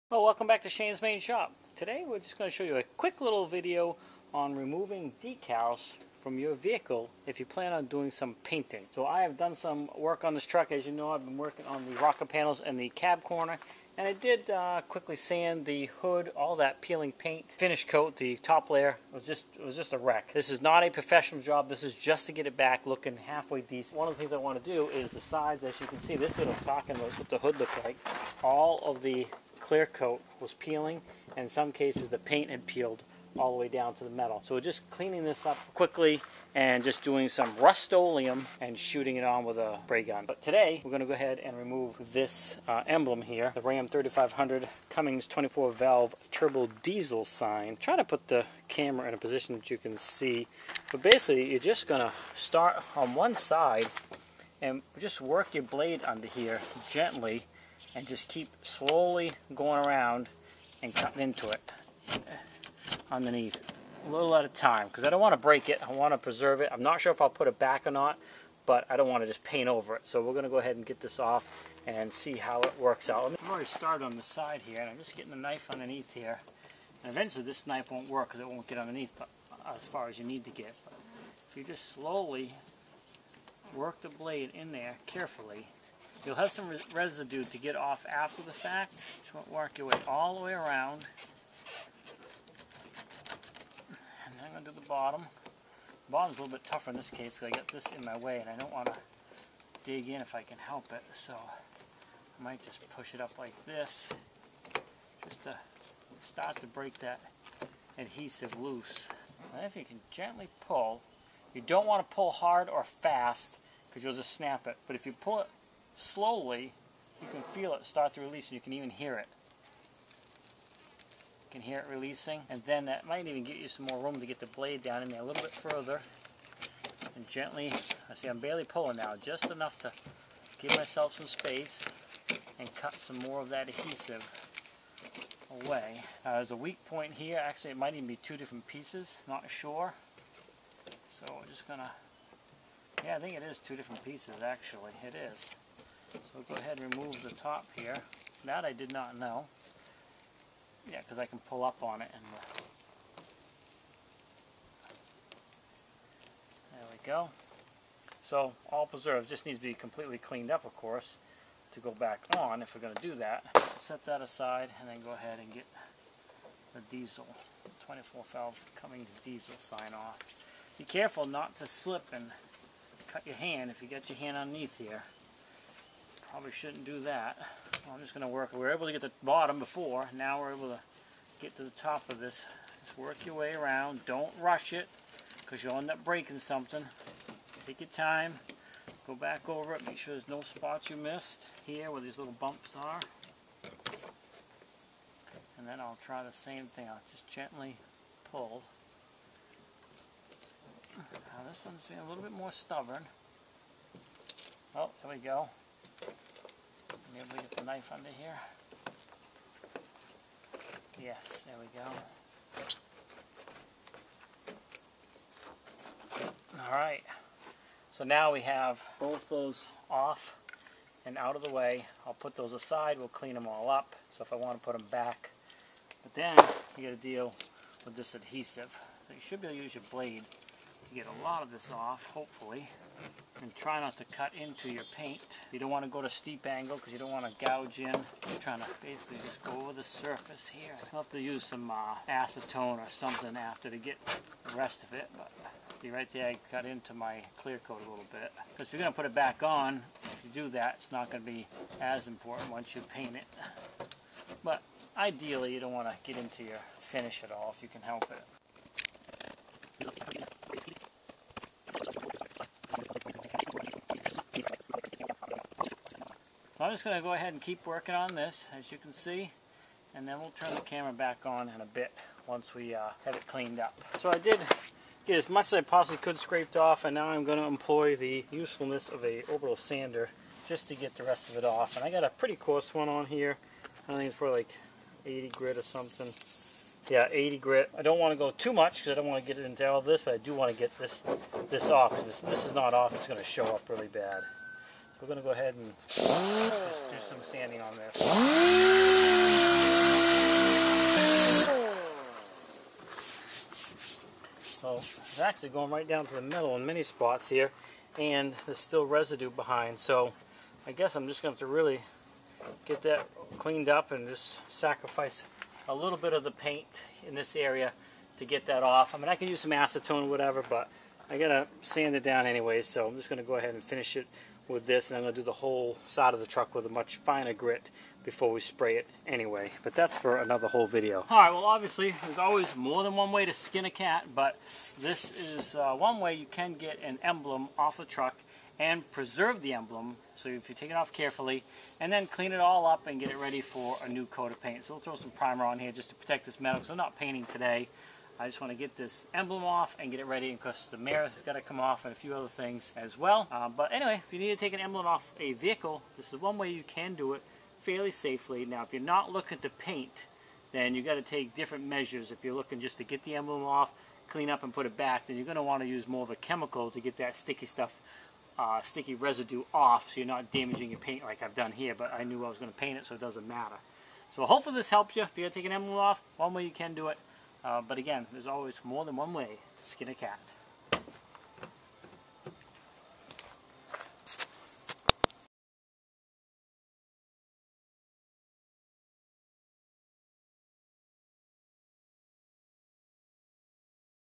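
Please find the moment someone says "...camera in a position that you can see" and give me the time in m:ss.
0:48.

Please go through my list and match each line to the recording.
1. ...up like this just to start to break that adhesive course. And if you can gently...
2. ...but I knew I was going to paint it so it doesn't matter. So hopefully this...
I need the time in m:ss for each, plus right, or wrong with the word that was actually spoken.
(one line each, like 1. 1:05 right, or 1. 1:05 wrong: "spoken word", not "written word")
1. 1:43 wrong: "loose", not "course"
2. 6:11 right.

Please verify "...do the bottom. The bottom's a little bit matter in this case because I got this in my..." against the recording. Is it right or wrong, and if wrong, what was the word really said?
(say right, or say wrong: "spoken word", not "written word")
wrong: "tougher", not "matter".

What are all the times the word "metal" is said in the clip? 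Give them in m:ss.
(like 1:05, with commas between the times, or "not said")
0:34, 5:06, 5:46.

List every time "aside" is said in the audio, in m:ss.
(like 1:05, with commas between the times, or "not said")
2:44, 3:42.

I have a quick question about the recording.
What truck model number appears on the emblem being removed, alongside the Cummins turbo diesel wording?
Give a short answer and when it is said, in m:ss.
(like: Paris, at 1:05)
3500, at 0:43.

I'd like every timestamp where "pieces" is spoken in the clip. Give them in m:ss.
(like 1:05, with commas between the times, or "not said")
2:18, 2:24.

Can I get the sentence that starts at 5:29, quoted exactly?
But that's for another whole video.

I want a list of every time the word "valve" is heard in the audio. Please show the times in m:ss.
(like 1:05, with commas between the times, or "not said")
0:45, 2:48.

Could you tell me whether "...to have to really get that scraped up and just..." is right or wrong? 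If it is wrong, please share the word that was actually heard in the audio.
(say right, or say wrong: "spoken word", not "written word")
wrong: "cleaned", not "scraped".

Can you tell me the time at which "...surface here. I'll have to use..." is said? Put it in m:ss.
3:59.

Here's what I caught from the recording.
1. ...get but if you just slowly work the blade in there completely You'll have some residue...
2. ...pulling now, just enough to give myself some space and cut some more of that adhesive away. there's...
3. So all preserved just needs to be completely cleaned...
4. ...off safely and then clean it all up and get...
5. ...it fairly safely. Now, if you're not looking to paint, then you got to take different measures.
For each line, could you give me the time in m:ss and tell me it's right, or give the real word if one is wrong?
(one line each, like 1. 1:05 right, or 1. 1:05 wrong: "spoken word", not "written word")
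1. 1:20 wrong: "carefully", not "completely"
2. 2:08 right
3. 2:38 right
4. 5:40 wrong: "carefully", not "safely"
5. 5:57 right.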